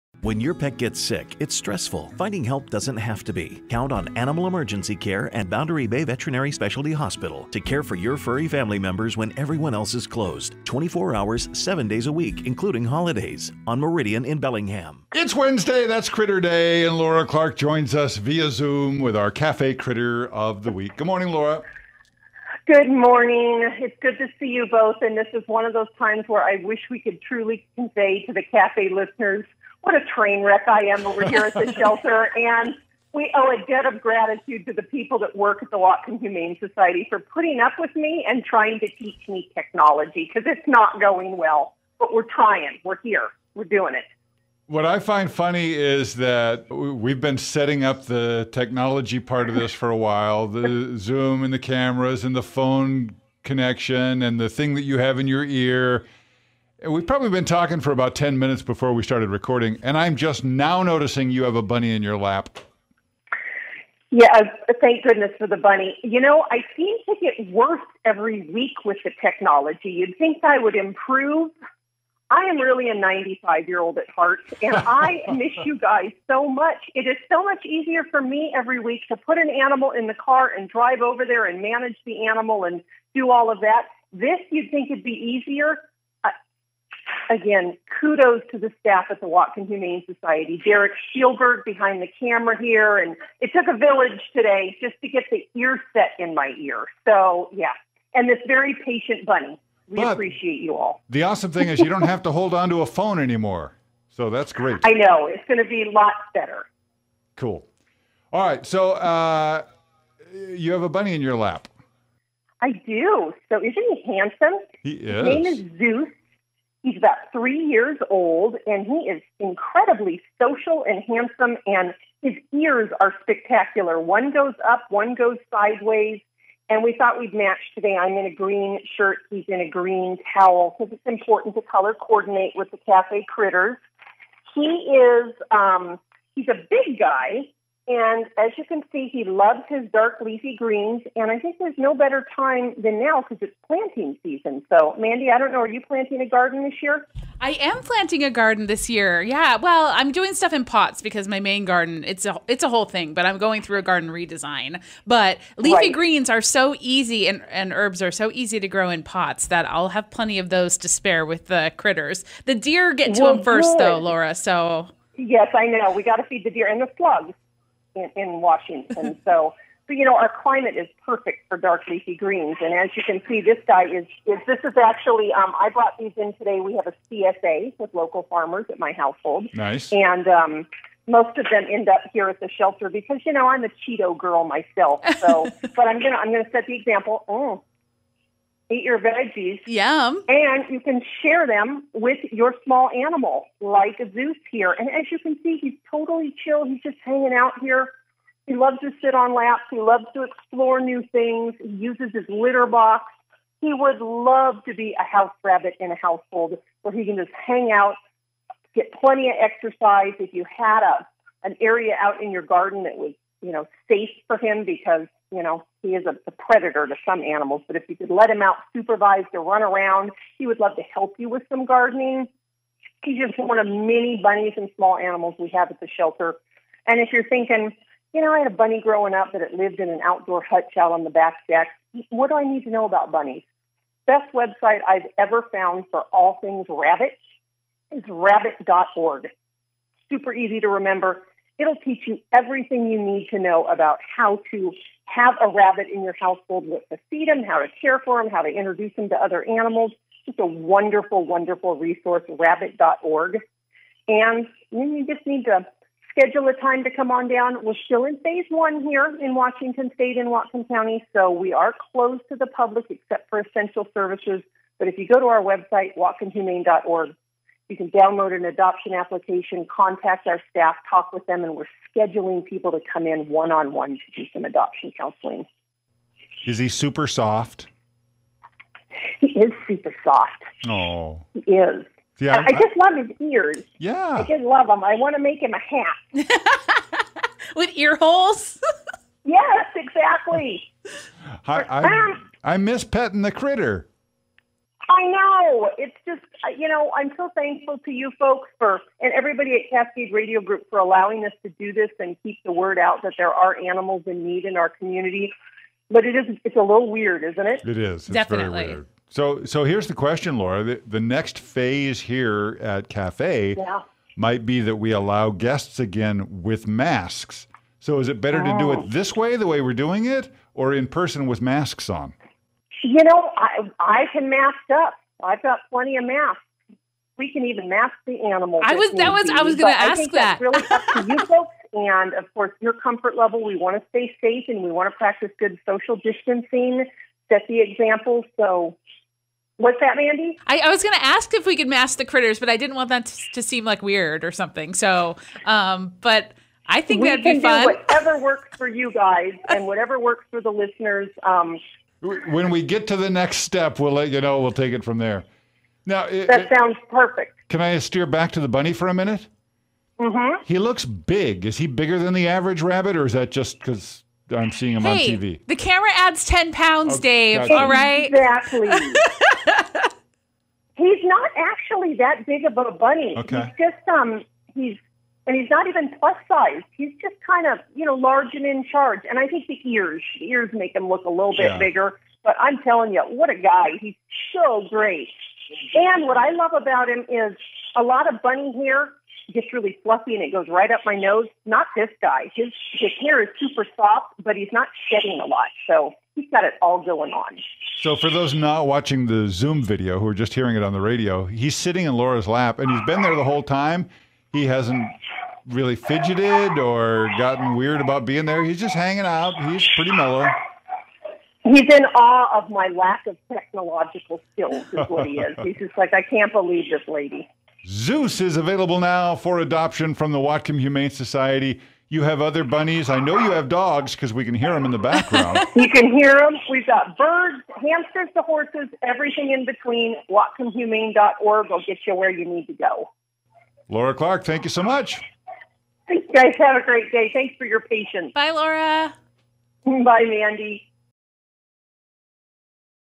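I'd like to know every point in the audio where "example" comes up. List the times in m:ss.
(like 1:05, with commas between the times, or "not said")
3:06, 5:37.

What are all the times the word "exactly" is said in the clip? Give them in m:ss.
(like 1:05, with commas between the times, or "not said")
4:49, 6:08.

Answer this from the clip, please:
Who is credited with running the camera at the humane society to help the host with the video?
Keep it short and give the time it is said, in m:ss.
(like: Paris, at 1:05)
Derek Spielberg, at 1:30.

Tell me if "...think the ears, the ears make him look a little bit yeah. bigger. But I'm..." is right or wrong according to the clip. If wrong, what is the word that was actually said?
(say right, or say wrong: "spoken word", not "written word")
right.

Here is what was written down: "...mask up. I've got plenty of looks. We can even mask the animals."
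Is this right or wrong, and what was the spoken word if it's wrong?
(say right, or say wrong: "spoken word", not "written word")
wrong: "masks", not "looks".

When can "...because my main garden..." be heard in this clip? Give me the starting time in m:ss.
2:31.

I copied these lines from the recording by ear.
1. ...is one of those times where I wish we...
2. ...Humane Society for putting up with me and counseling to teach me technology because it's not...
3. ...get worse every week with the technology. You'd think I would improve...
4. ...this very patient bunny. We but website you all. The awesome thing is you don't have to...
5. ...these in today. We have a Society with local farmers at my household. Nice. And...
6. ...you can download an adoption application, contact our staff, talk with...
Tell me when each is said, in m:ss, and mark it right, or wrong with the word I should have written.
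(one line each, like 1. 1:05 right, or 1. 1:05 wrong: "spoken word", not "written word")
1. 0:25 right
2. 0:36 wrong: "trying", not "counseling"
3. 1:07 right
4. 1:38 wrong: "appreciate", not "website"
5. 2:55 wrong: "CSA", not "Society"
6. 4:27 right.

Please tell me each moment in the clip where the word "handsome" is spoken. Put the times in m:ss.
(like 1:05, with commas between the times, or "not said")
1:54, 2:01.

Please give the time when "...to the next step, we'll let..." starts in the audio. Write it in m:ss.
5:52.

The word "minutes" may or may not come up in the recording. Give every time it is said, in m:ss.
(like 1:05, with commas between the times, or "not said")
0:58, 5:58.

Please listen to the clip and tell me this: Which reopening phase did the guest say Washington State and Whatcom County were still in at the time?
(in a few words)
Phase one.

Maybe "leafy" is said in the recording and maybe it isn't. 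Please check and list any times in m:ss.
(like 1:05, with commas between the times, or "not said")
2:20, 2:35, 2:51.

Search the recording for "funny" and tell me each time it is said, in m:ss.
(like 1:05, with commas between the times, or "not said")
0:45.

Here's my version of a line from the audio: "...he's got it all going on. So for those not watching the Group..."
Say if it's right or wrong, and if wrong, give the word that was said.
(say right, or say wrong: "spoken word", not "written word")
wrong: "Zoom", not "Group".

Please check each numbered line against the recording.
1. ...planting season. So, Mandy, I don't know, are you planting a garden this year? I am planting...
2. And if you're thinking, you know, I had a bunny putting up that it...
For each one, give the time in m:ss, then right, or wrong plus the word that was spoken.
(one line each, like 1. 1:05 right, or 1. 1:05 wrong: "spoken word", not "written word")
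1. 2:23 right
2. 3:46 wrong: "growing", not "putting".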